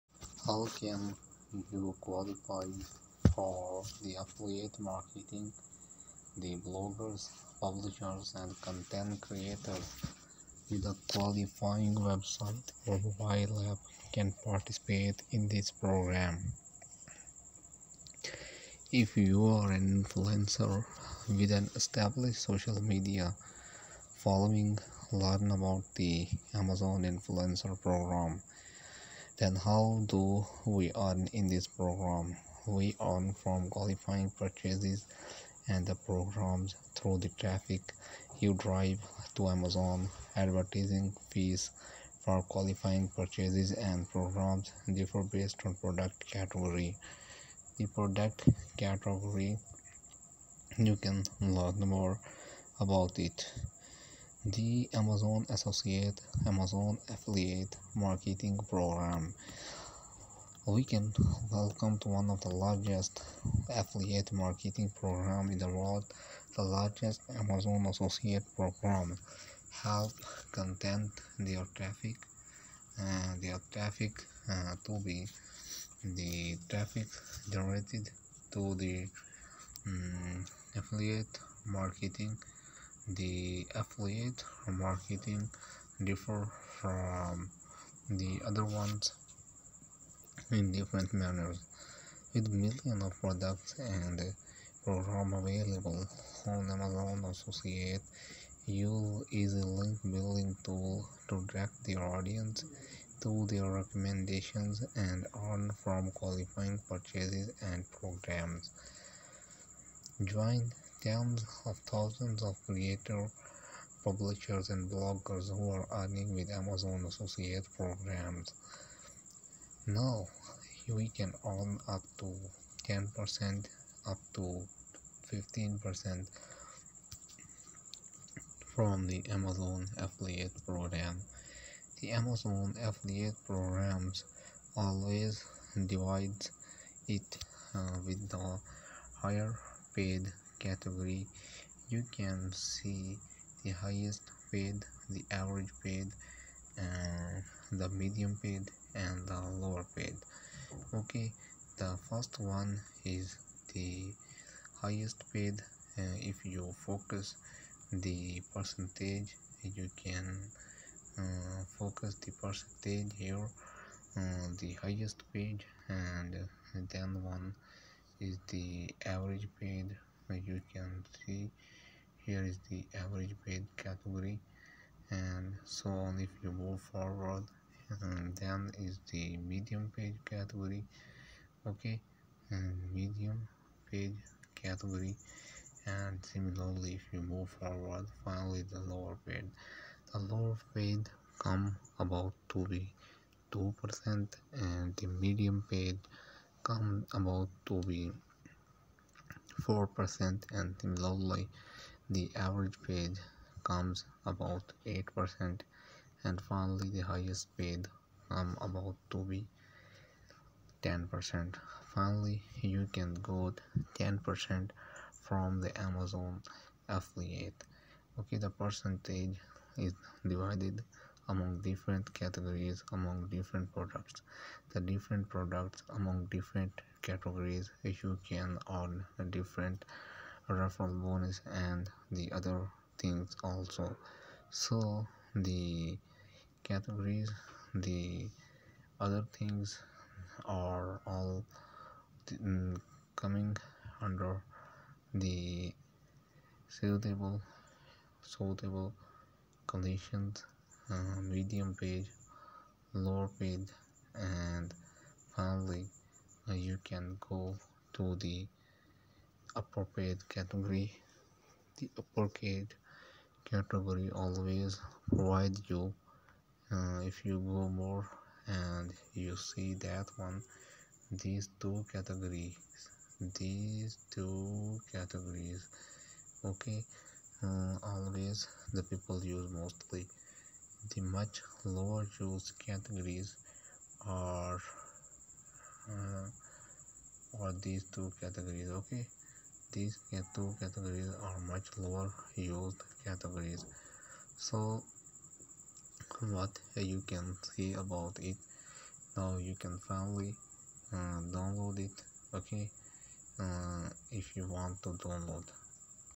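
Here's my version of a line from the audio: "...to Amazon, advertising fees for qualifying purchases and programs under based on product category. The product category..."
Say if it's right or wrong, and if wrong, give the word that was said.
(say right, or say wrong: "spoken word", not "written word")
wrong: "differ", not "under".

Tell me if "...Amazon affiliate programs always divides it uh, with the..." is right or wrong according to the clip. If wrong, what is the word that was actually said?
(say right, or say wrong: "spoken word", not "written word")
right.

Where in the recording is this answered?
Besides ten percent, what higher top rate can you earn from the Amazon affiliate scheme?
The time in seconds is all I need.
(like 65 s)
124 s.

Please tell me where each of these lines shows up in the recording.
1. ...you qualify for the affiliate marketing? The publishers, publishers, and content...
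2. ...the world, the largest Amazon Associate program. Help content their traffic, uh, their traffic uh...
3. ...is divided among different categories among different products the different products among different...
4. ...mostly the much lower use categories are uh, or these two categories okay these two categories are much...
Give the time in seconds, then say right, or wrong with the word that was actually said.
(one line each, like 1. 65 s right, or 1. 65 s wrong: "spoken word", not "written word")
1. 1 s wrong: "bloggers", not "publishers"
2. 65 s right
3. 219 s right
4. 279 s right.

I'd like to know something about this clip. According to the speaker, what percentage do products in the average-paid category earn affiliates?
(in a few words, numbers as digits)
8%.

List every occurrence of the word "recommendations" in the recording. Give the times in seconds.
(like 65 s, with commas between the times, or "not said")
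103 s.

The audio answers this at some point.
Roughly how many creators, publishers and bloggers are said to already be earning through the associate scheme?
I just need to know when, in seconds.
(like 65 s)
111 s.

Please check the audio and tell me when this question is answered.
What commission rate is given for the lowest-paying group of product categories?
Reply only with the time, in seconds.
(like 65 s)
193 s.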